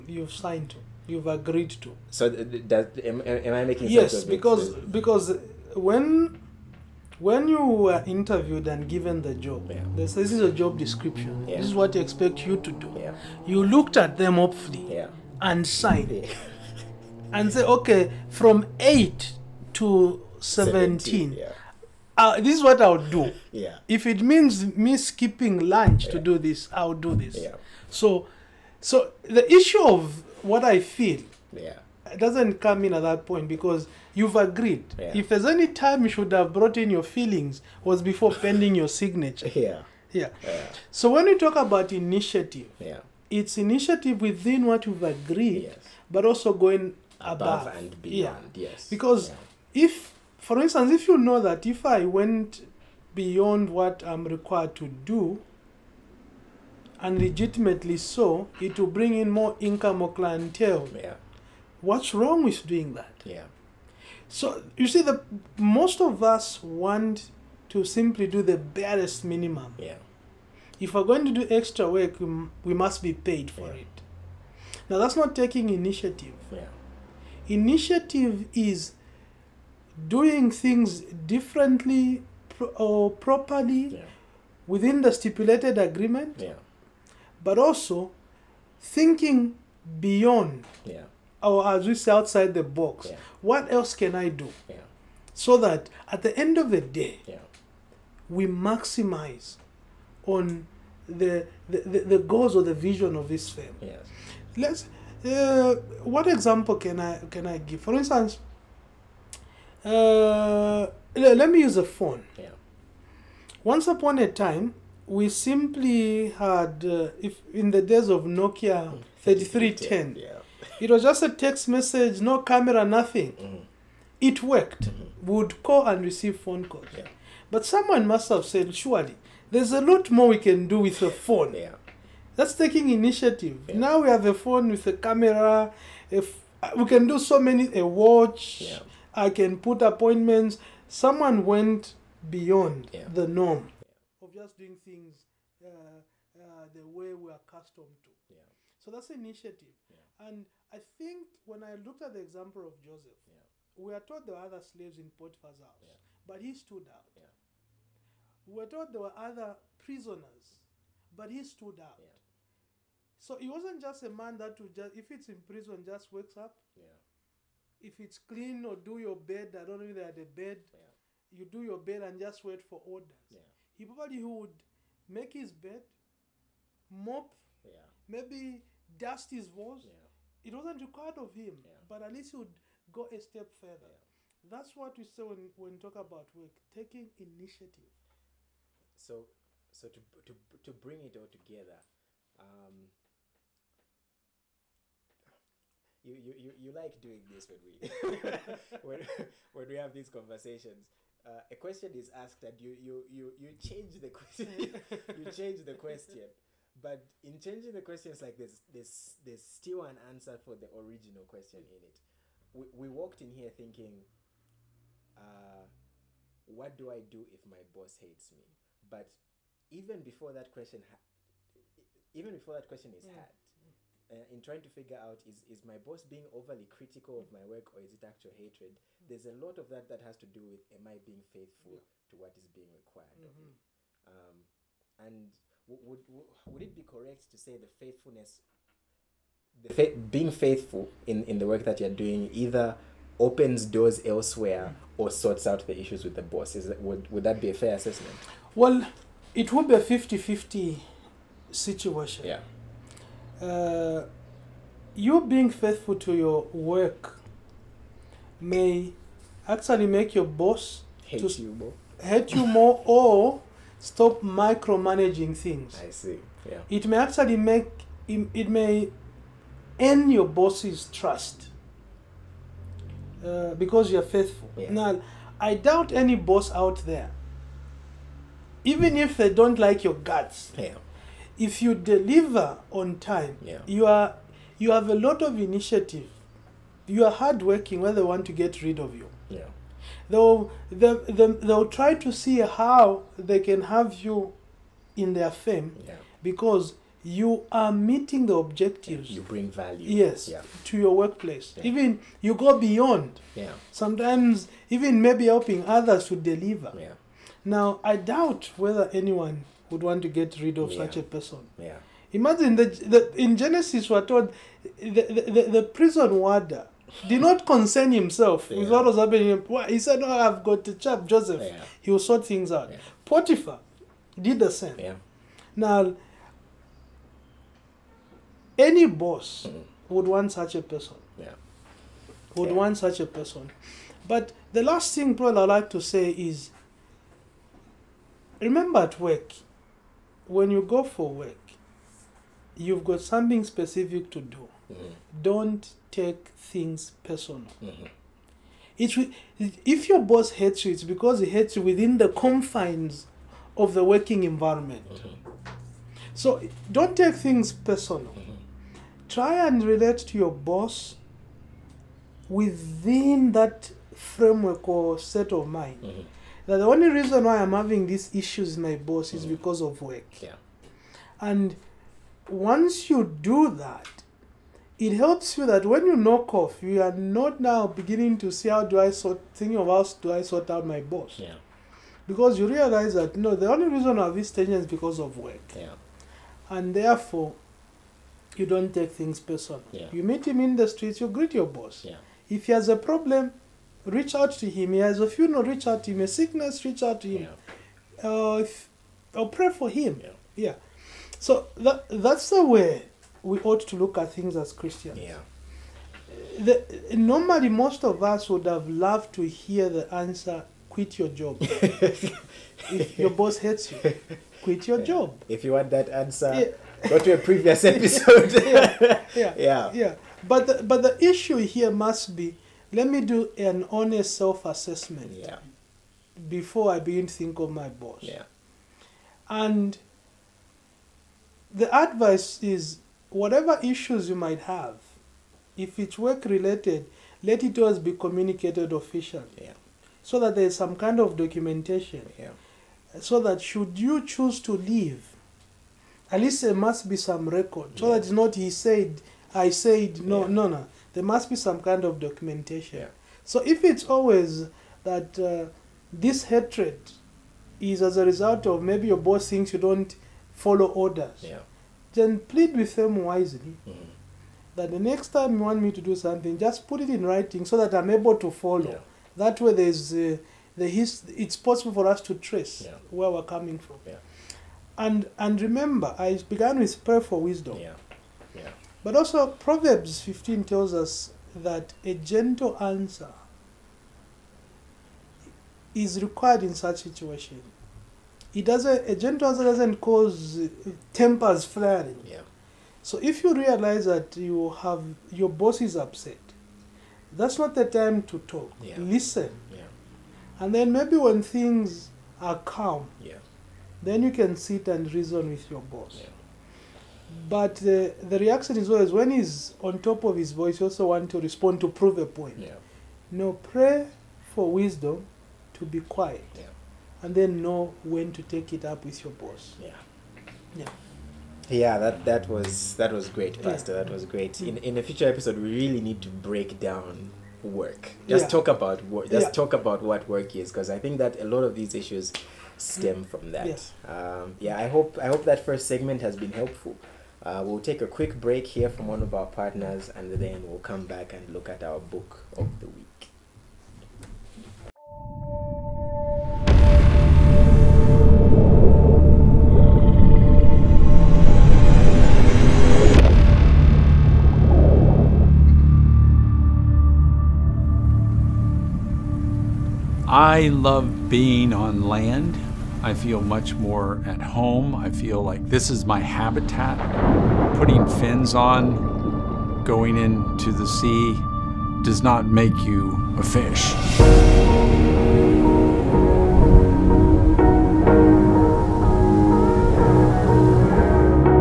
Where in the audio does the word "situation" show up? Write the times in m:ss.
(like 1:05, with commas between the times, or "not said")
4:11, 8:06.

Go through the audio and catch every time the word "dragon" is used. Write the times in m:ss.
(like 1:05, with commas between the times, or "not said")
not said.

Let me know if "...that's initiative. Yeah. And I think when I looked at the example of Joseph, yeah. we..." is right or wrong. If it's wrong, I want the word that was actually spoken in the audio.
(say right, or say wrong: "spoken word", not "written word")
right.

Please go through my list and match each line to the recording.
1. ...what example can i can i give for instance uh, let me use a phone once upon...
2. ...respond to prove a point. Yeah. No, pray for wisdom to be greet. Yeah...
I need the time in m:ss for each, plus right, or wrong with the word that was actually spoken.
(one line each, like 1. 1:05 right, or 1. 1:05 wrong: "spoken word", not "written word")
1. 1:46 right
2. 8:31 wrong: "quiet", not "greet".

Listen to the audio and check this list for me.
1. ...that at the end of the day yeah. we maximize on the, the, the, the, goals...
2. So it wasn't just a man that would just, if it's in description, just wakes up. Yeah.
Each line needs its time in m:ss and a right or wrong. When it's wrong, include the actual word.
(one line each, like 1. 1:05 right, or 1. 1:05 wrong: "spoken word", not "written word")
1. 1:35 right
2. 2:43 wrong: "prison", not "description".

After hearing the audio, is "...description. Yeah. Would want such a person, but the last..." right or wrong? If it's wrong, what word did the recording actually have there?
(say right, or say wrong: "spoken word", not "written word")
wrong: "person", not "description".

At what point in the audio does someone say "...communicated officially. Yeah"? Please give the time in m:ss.
7:17.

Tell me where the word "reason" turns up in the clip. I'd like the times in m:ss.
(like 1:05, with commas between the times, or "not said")
6:06, 6:23, 8:24.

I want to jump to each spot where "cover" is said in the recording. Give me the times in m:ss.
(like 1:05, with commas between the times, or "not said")
not said.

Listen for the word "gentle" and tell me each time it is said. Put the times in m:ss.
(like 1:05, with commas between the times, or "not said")
8:01, 8:08.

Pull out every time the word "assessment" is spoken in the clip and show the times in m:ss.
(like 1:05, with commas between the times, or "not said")
4:07, 7:04.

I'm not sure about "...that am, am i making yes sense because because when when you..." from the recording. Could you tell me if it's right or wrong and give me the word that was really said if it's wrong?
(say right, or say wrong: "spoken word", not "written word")
right.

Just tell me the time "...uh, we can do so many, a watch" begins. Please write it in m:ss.
2:16.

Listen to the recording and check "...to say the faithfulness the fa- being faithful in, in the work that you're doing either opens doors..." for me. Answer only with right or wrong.
right.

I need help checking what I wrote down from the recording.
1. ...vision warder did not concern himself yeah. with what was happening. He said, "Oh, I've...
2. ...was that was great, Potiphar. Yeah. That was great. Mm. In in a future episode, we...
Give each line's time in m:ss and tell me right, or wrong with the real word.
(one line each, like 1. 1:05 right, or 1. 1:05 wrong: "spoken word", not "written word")
1. 5:15 wrong: "prison", not "vision"
2. 8:42 wrong: "Pastor", not "Potiphar".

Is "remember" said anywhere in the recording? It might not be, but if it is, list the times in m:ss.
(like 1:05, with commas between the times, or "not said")
5:38, 7:55.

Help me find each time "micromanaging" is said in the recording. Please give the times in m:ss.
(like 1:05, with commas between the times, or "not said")
4:24.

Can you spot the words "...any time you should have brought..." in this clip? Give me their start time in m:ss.
0:35.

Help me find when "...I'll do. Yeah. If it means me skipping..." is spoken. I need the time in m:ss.
0:22.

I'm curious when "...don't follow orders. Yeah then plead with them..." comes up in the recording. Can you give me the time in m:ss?
7:39.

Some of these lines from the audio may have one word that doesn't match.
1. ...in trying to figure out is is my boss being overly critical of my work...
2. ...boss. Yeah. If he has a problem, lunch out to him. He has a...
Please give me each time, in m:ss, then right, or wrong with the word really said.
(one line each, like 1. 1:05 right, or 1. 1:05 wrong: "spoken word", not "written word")
1. 3:44 right
2. 6:31 wrong: "reach", not "lunch".